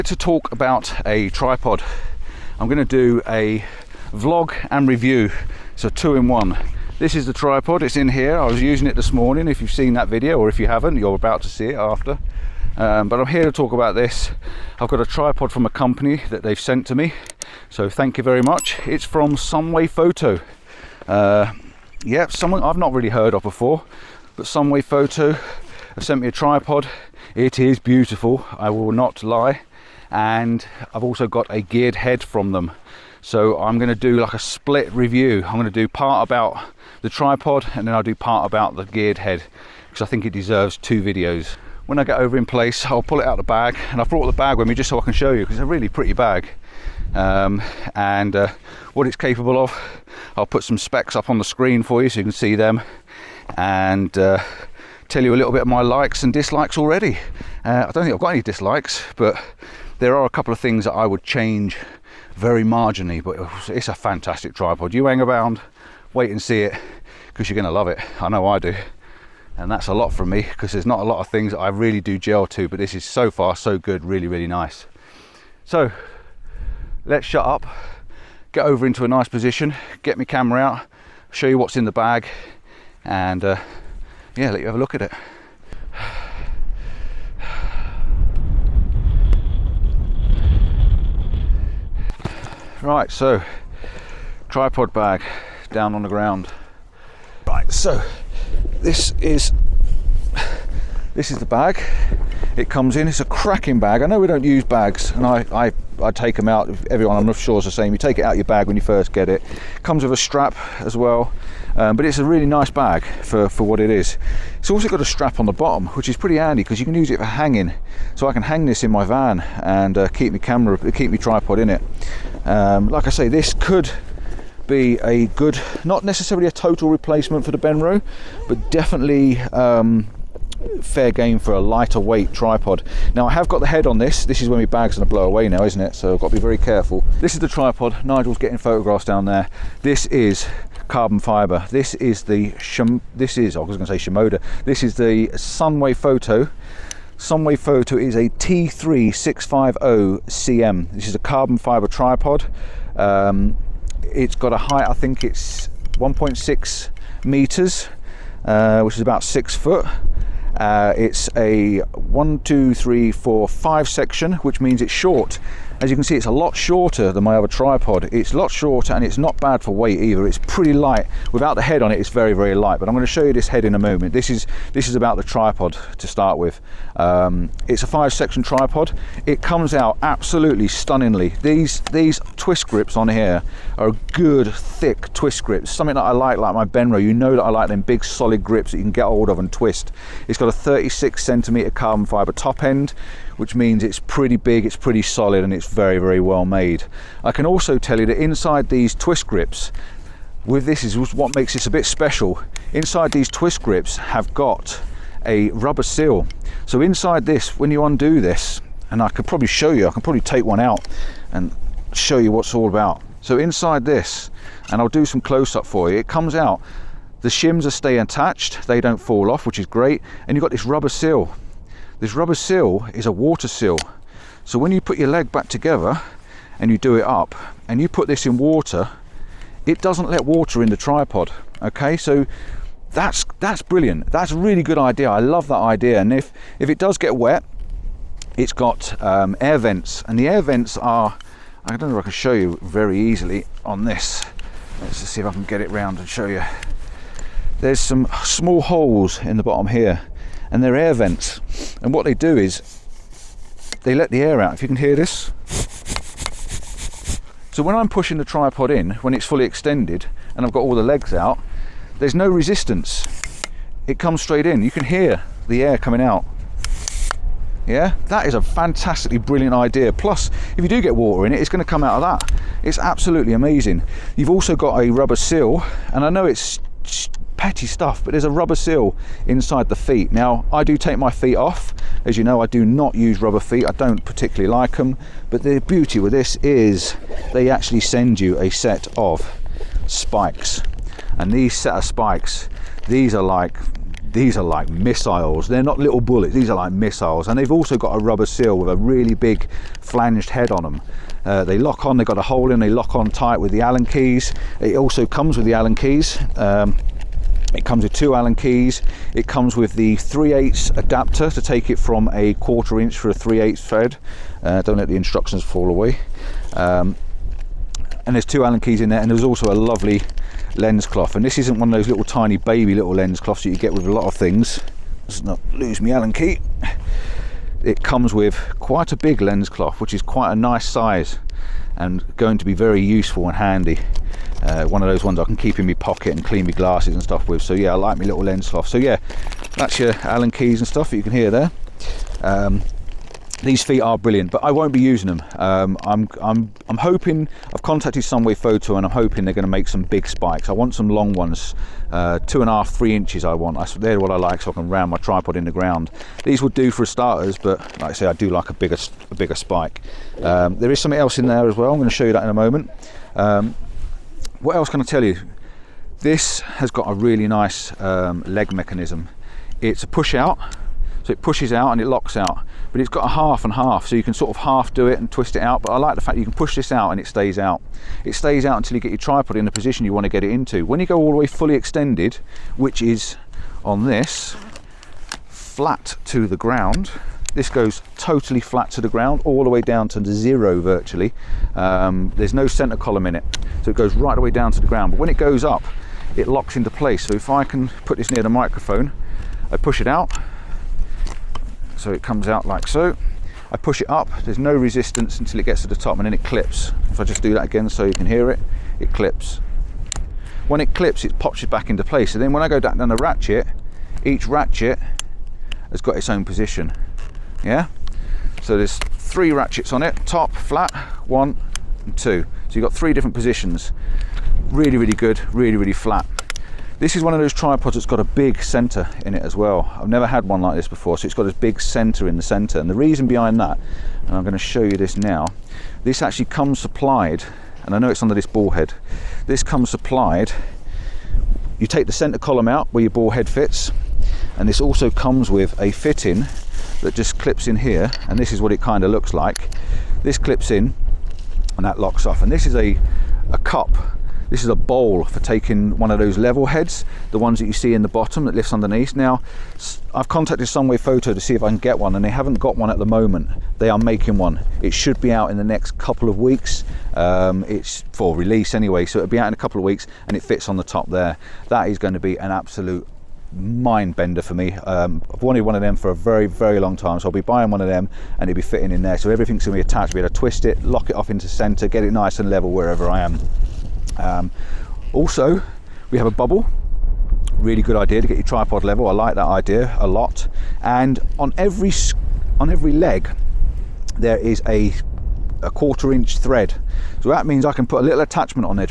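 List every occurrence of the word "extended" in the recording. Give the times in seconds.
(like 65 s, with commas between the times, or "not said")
259 s, 381 s.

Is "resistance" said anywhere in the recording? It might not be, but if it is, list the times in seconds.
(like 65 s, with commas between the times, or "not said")
262 s, 404 s.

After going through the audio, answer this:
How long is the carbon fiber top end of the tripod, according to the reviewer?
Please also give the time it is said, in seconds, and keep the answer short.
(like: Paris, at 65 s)
36 centimeters, at 190 s.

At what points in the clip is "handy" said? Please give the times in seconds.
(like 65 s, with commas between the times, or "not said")
116 s, 333 s.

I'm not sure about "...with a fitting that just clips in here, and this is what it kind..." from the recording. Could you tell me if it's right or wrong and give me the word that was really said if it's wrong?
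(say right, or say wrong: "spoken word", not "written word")
right.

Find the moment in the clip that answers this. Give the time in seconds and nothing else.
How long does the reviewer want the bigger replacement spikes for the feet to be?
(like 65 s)
352 s.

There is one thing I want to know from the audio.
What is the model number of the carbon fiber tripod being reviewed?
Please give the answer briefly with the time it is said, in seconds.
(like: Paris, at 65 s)
T3650CM, at 148 s.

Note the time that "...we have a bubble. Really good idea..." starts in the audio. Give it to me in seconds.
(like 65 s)
485 s.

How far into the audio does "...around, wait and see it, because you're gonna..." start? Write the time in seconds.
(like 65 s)
65 s.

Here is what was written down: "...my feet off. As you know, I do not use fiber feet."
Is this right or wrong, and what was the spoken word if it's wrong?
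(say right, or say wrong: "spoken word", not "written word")
wrong: "rubber", not "fiber".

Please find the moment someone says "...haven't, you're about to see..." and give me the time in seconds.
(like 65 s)
10 s.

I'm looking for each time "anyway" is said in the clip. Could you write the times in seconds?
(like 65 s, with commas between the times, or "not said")
468 s.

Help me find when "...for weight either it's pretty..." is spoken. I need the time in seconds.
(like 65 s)
169 s.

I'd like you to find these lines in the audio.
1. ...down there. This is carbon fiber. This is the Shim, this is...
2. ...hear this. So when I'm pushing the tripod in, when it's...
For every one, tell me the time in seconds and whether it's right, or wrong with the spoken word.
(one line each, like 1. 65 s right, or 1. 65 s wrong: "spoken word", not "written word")
1. 139 s right
2. 254 s right.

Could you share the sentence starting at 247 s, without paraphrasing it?
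There's some small holes in the bottom here and they're air vents.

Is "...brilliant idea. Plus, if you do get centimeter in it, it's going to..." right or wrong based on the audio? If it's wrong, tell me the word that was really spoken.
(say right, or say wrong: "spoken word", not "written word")
wrong: "water", not "centimeter".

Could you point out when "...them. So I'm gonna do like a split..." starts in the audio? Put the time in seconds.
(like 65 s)
32 s.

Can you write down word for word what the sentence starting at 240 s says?
And the air vents are, I don't know if I can show you very easily on this.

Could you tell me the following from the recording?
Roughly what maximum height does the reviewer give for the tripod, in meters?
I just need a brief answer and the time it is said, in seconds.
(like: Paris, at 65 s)
1.6 meters, at 155 s.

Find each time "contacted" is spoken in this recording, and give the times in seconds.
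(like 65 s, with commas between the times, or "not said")
347 s, 460 s.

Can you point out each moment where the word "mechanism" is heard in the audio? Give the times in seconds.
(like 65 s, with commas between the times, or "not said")
368 s.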